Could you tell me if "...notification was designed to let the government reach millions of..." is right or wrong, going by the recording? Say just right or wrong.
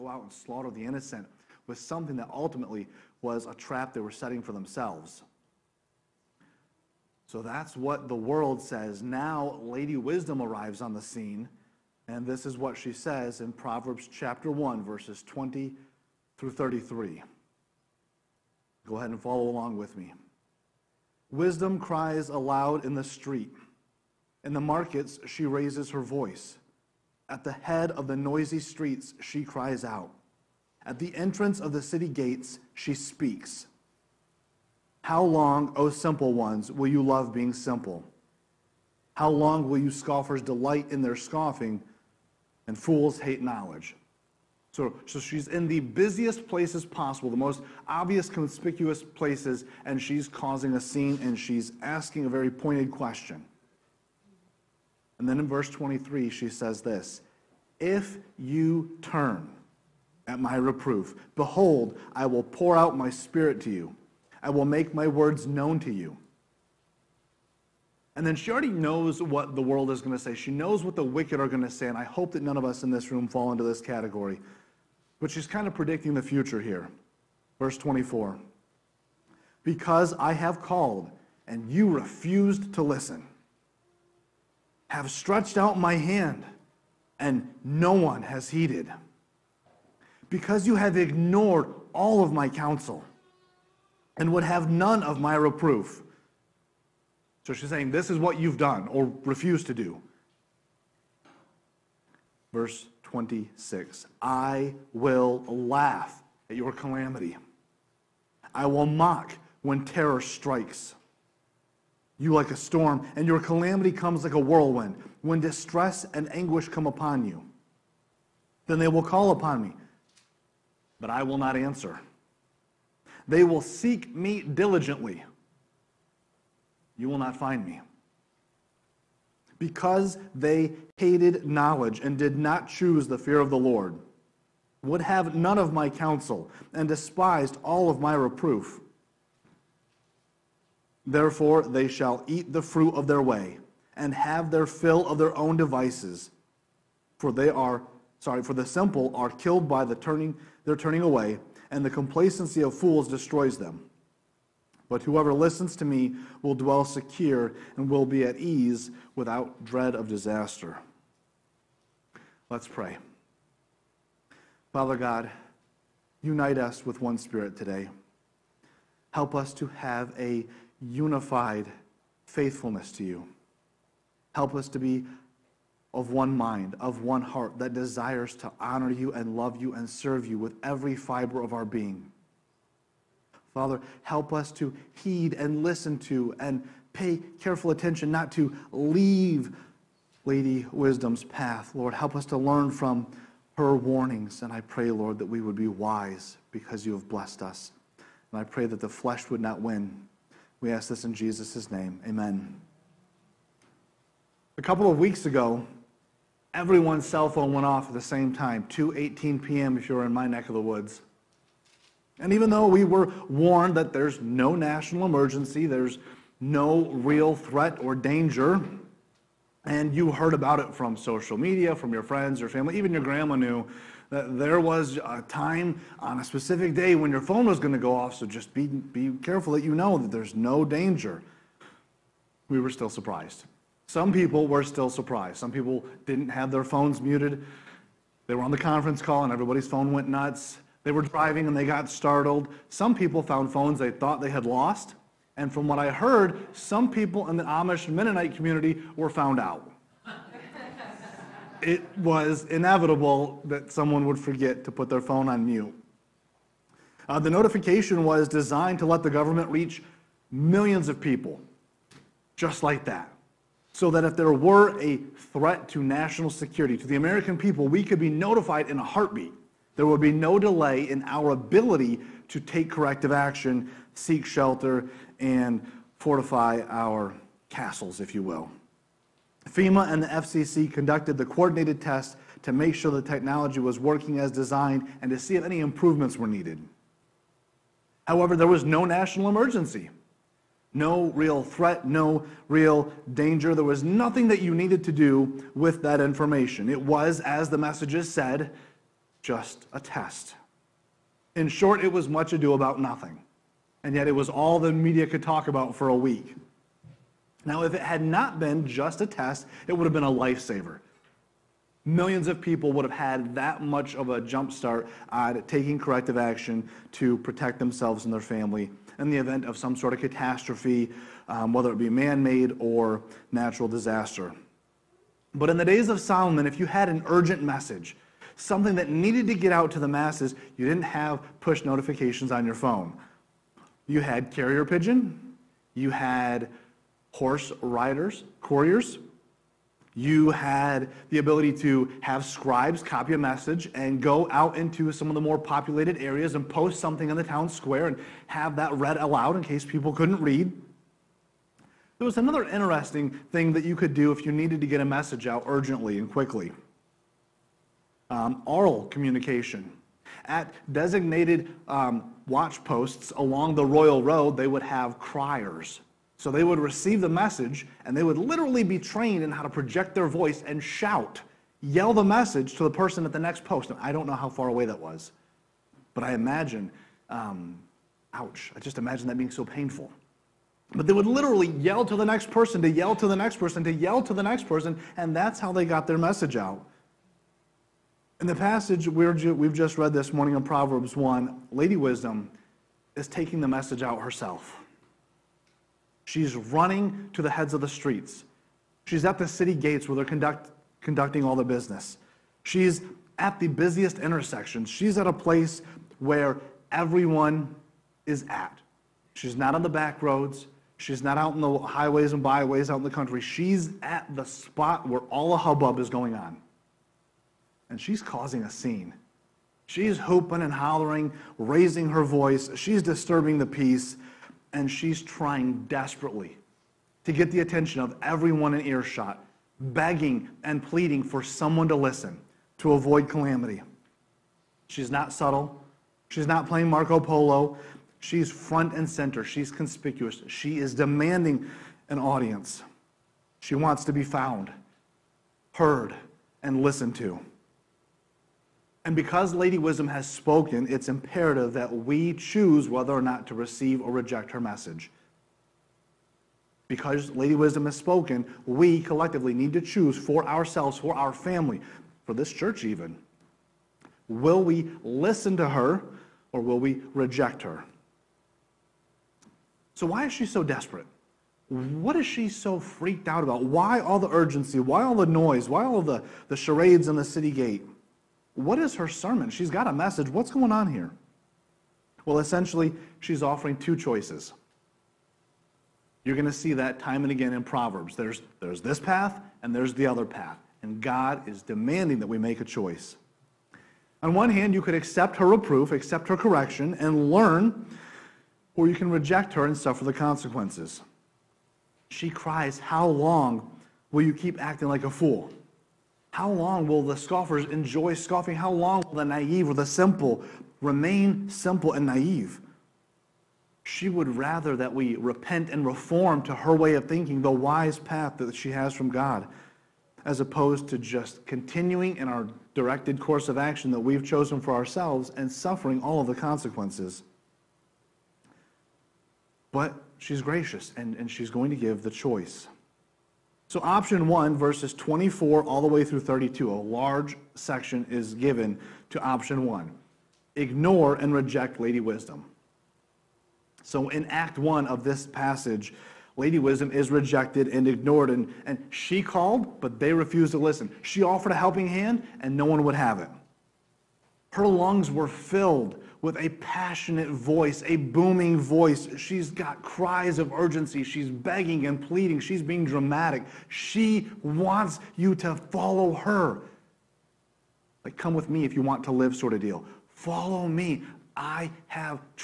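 right.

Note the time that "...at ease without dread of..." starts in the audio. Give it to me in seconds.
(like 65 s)
158 s.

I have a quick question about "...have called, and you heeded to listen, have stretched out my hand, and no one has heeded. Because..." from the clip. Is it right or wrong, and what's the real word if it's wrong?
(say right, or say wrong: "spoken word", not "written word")
wrong: "refused", not "heeded".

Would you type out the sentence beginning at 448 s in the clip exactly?
And because Lady Wisdom has spoken, it's imperative that we choose whether or not to receive or reject her message.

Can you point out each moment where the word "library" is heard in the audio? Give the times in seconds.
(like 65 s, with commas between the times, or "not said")
not said.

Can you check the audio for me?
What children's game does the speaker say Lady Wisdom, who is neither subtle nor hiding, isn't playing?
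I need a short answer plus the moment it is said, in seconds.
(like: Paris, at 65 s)
Marco Polo, at 436 s.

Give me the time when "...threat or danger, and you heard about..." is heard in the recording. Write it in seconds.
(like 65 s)
217 s.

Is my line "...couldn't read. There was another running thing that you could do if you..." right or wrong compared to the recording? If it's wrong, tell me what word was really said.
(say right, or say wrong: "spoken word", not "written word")
wrong: "interesting", not "running".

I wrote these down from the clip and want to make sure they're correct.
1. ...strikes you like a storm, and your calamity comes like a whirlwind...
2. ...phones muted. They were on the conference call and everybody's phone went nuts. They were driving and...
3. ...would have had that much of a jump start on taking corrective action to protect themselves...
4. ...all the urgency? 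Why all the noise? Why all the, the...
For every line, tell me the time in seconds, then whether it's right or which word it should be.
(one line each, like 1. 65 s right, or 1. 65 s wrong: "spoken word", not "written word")
1. 110 s right
2. 236 s right
3. 312 s right
4. 473 s right.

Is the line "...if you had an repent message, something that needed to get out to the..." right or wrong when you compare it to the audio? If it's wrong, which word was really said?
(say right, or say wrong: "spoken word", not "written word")
wrong: "urgent", not "repent".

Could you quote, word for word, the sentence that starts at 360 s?
At designated um, watch posts along the royal road, they would have criers.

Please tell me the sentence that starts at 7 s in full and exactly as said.
So that's what the world says.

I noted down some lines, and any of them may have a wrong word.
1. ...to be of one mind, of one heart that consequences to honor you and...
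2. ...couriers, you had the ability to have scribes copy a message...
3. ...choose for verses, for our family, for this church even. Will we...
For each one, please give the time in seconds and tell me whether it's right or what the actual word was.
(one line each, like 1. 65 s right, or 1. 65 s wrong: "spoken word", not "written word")
1. 174 s wrong: "desires", not "consequences"
2. 338 s right
3. 459 s wrong: "ourselves", not "verses".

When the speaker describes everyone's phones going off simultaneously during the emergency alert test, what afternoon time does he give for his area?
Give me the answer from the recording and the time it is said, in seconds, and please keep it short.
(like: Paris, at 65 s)
2:18 p.m., at 208 s.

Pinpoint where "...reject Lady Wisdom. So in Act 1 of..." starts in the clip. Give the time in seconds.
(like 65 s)
541 s.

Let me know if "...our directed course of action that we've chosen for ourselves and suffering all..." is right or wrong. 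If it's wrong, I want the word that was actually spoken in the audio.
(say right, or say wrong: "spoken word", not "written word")
right.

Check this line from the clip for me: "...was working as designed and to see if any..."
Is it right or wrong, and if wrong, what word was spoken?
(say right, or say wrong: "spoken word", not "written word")
right.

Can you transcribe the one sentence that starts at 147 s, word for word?
For they are, sorry, for the simple are killed by the turning, their turning away, and the complacency of fools destroys them.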